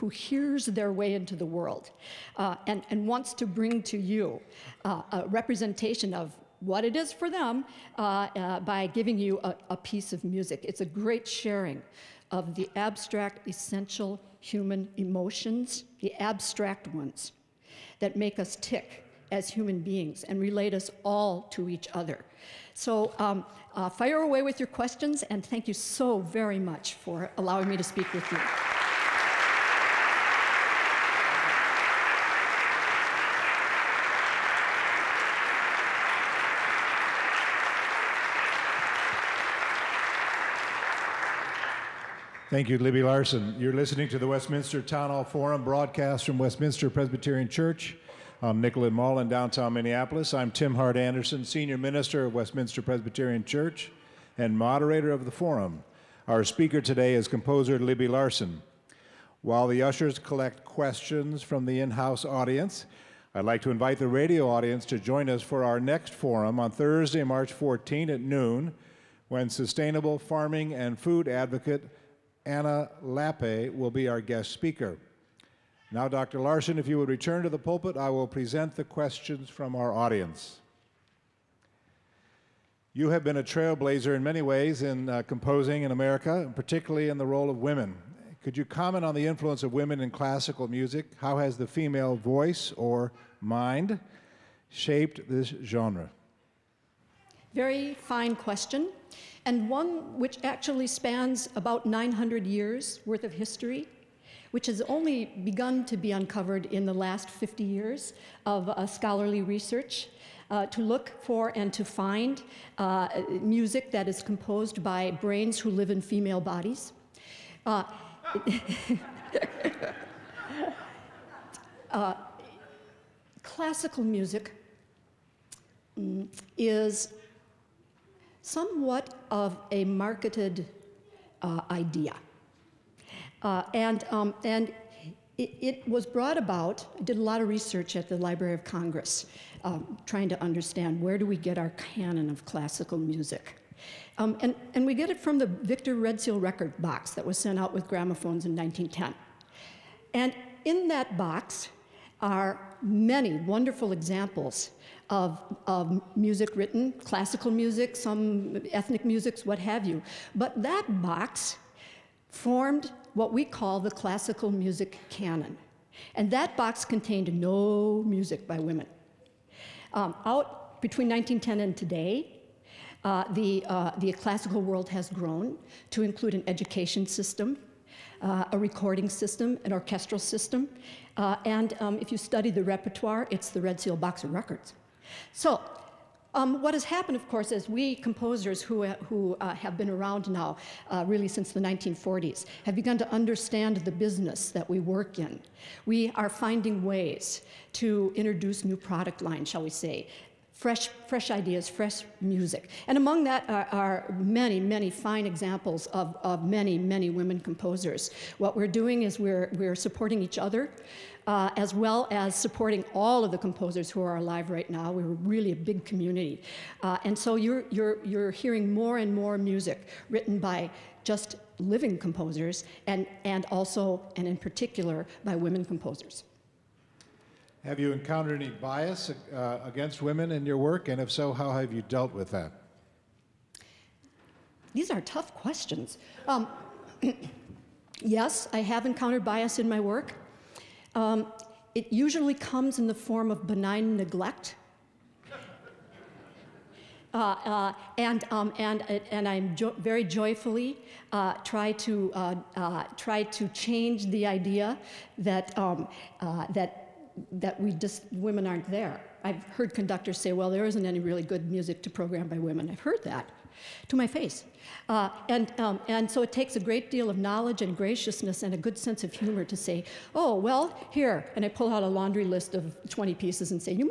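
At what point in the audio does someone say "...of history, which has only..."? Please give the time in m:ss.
1:43.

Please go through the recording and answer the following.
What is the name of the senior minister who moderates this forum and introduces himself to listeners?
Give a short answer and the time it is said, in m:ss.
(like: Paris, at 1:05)
Tim Hart Andersen, at 0:50.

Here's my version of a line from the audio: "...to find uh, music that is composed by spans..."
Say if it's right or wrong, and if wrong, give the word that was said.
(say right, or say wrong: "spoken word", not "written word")
wrong: "brains", not "spans".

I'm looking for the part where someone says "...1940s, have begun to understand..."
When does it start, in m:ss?
3:11.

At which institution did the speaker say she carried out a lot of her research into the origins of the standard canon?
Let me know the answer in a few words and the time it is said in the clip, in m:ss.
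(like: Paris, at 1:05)
Library of Congress, at 2:18.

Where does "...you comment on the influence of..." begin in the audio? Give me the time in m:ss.
1:28.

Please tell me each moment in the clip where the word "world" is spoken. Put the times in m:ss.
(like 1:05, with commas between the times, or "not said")
0:01, 2:54.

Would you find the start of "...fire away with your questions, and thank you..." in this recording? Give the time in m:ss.
0:23.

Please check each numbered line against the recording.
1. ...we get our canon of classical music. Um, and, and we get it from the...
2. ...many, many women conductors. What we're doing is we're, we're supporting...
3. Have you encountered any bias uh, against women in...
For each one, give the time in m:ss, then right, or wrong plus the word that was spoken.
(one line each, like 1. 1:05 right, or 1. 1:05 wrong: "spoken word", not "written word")
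1. 2:21 right
2. 3:26 wrong: "composers", not "conductors"
3. 3:47 right.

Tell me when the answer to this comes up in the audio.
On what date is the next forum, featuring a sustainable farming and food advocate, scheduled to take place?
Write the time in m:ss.
1:07.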